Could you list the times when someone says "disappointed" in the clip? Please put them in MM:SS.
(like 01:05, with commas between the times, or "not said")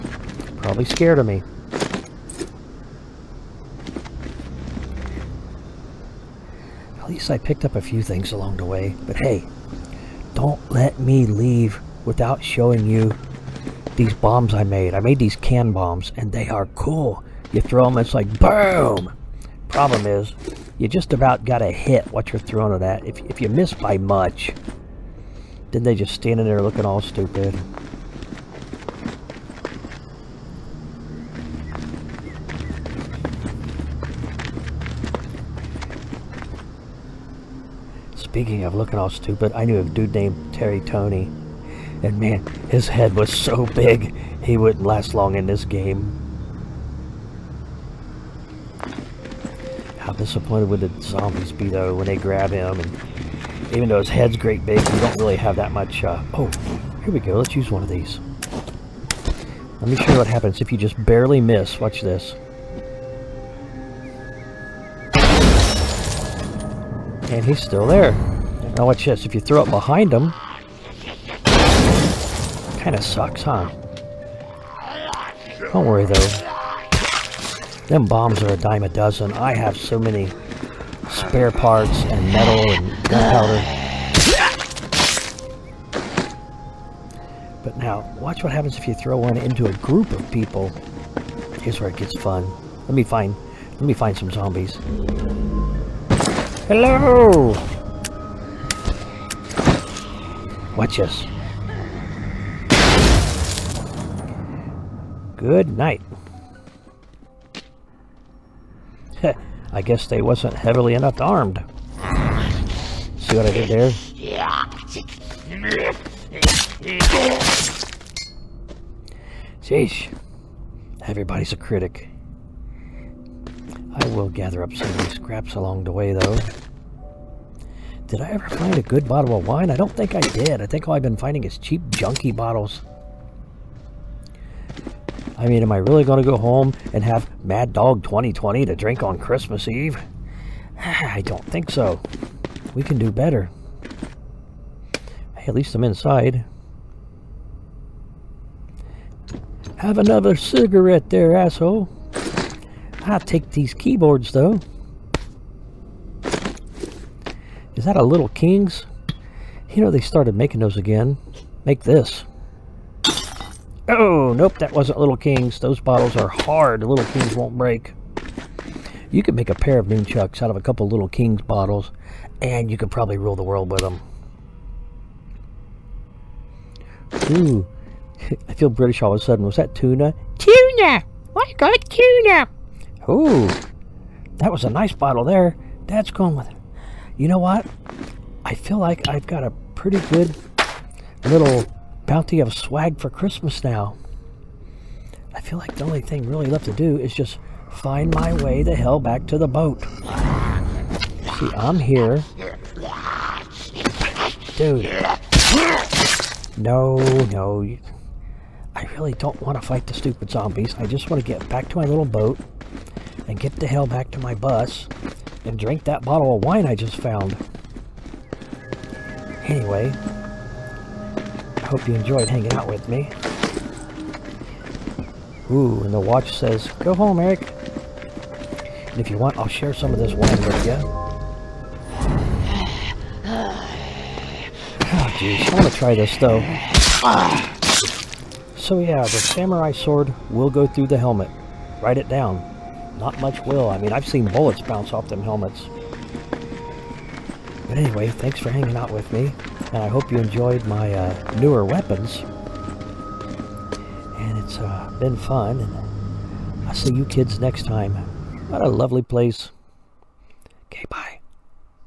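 00:50.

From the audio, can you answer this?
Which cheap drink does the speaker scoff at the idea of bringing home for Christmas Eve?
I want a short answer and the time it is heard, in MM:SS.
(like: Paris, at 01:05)
Mad Dog 2020, at 02:17.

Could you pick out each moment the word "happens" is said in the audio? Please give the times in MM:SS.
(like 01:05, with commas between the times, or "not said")
01:00, 01:28.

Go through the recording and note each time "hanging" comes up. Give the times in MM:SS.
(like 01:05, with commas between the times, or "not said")
03:42, 04:08.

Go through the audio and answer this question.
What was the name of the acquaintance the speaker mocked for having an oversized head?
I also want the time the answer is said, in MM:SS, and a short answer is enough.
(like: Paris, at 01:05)
Terry Tony, at 00:40.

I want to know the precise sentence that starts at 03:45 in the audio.
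Ooh, and the watch says, go home, Eric.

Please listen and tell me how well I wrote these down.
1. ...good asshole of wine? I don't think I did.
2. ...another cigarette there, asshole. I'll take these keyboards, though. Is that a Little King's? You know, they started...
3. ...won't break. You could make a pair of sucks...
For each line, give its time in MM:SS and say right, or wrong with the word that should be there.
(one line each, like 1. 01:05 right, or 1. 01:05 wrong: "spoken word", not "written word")
1. 02:08 wrong: "bottle", not "asshole"
2. 02:29 right
3. 02:47 wrong: "nunchucks", not "sucks".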